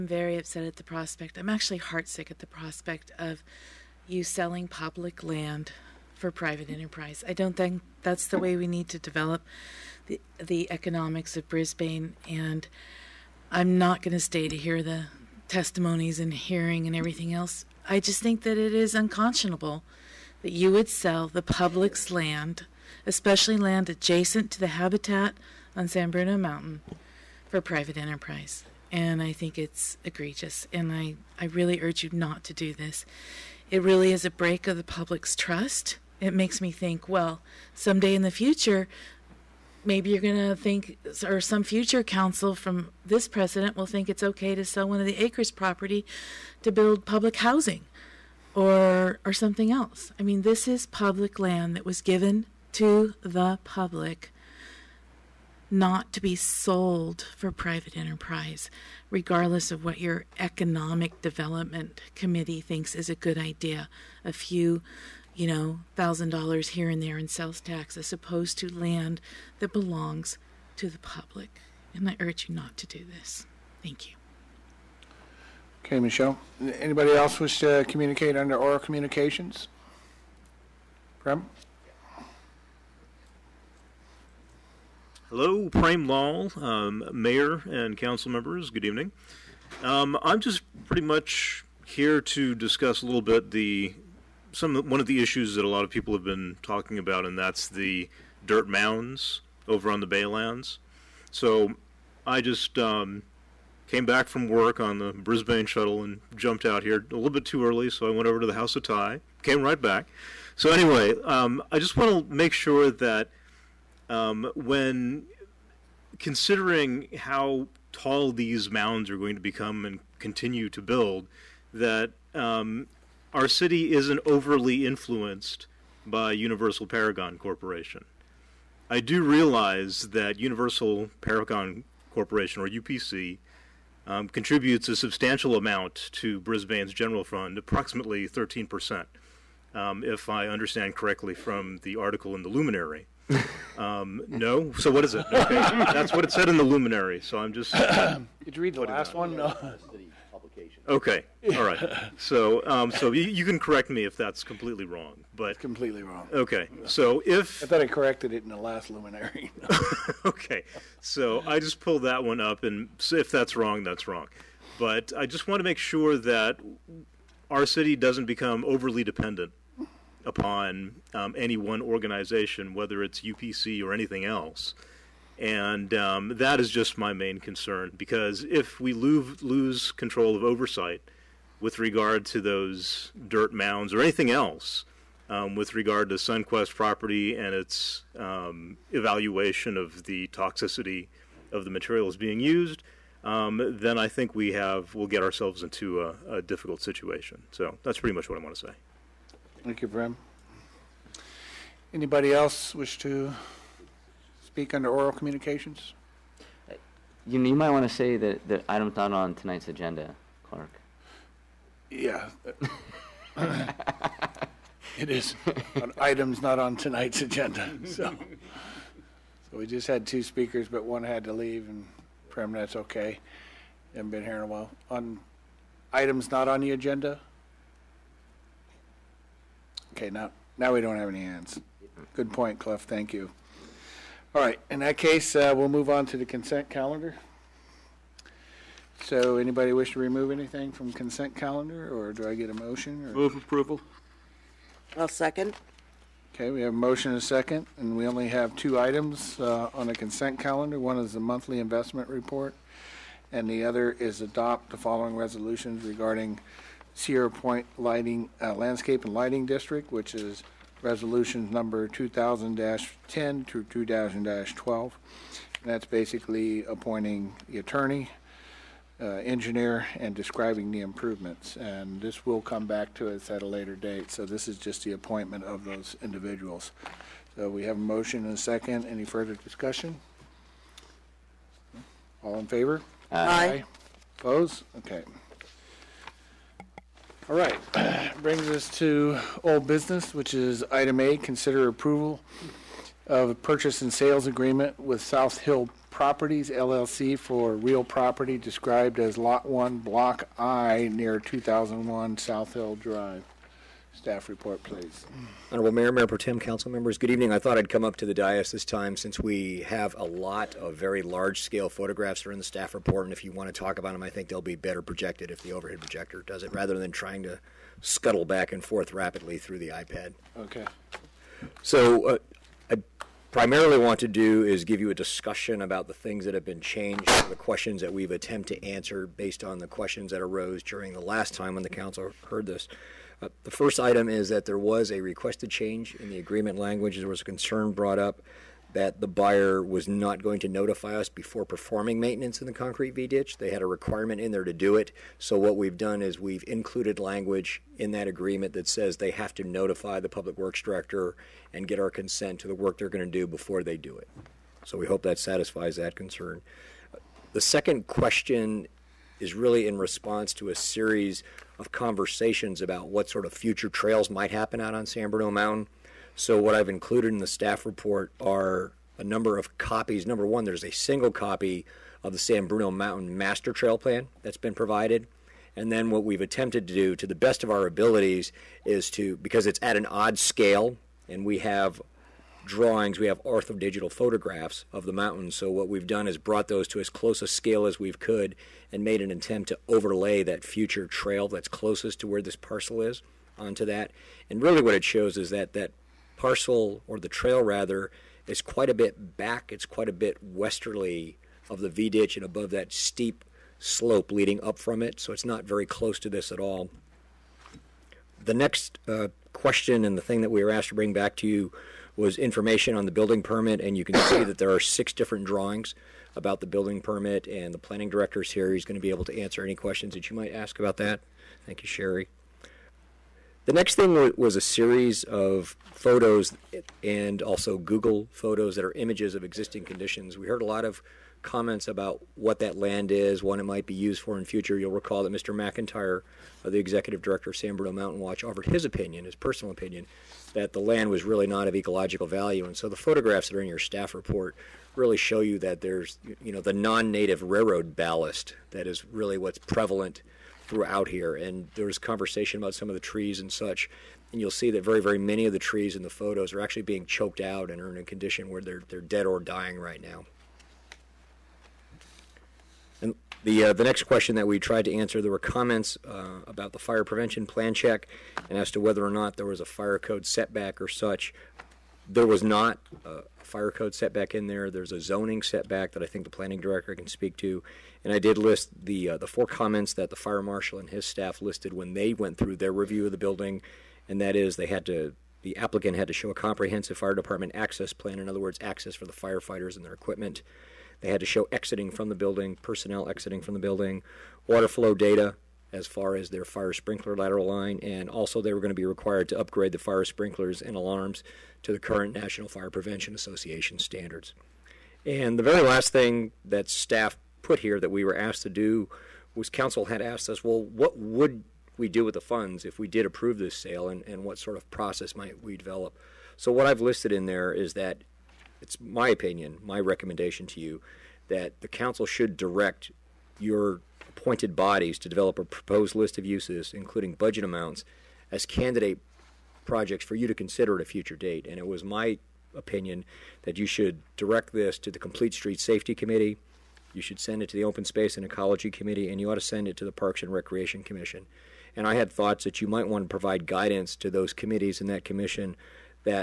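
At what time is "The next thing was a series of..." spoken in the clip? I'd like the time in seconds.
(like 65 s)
423 s.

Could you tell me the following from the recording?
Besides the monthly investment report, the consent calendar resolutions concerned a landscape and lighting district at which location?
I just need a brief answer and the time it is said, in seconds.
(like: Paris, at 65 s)
Sierra Point, at 256 s.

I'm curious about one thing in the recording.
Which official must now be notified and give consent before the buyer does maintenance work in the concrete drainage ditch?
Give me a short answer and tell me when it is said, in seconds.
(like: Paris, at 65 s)
Public works director, at 350 s.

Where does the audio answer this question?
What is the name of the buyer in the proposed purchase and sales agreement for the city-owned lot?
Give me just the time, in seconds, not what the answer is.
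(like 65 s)
295 s.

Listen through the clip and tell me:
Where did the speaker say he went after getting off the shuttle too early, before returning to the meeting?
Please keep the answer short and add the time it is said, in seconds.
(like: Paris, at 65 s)
House of Thai, at 108 s.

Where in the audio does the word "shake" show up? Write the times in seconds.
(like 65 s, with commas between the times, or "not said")
not said.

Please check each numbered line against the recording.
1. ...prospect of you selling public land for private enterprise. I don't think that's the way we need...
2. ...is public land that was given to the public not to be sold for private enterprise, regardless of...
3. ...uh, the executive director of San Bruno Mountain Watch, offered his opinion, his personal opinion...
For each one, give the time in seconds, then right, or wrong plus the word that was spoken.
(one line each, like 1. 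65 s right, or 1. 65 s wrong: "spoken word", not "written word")
1. 2 s right
2. 50 s right
3. 436 s right.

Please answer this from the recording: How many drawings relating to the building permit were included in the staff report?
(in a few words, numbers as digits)
6.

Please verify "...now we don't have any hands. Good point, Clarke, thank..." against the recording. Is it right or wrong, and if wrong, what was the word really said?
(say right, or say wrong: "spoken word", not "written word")
wrong: "Cliff", not "Clarke".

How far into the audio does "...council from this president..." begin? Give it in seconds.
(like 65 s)
42 s.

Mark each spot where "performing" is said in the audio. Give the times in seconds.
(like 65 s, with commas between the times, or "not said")
341 s.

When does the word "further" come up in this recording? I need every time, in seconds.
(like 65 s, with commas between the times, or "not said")
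279 s.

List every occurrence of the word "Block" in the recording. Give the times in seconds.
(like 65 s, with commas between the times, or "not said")
299 s.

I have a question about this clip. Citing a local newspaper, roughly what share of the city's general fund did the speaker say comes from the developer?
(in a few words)
13%.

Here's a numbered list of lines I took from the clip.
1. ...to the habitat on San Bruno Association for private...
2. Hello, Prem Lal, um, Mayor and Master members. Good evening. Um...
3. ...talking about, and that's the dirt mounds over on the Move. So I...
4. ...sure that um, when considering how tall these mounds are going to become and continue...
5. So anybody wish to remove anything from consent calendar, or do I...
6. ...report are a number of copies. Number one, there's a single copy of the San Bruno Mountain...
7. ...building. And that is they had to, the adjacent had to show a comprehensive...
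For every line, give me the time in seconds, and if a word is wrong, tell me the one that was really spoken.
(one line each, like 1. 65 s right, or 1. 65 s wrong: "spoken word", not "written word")
1. 24 s wrong: "Mountain", not "Association"
2. 85 s wrong: "Council", not "Master"
3. 96 s wrong: "Baylands", not "Move"
4. 112 s right
5. 239 s right
6. 367 s right
7. 482 s wrong: "applicant", not "adjacent".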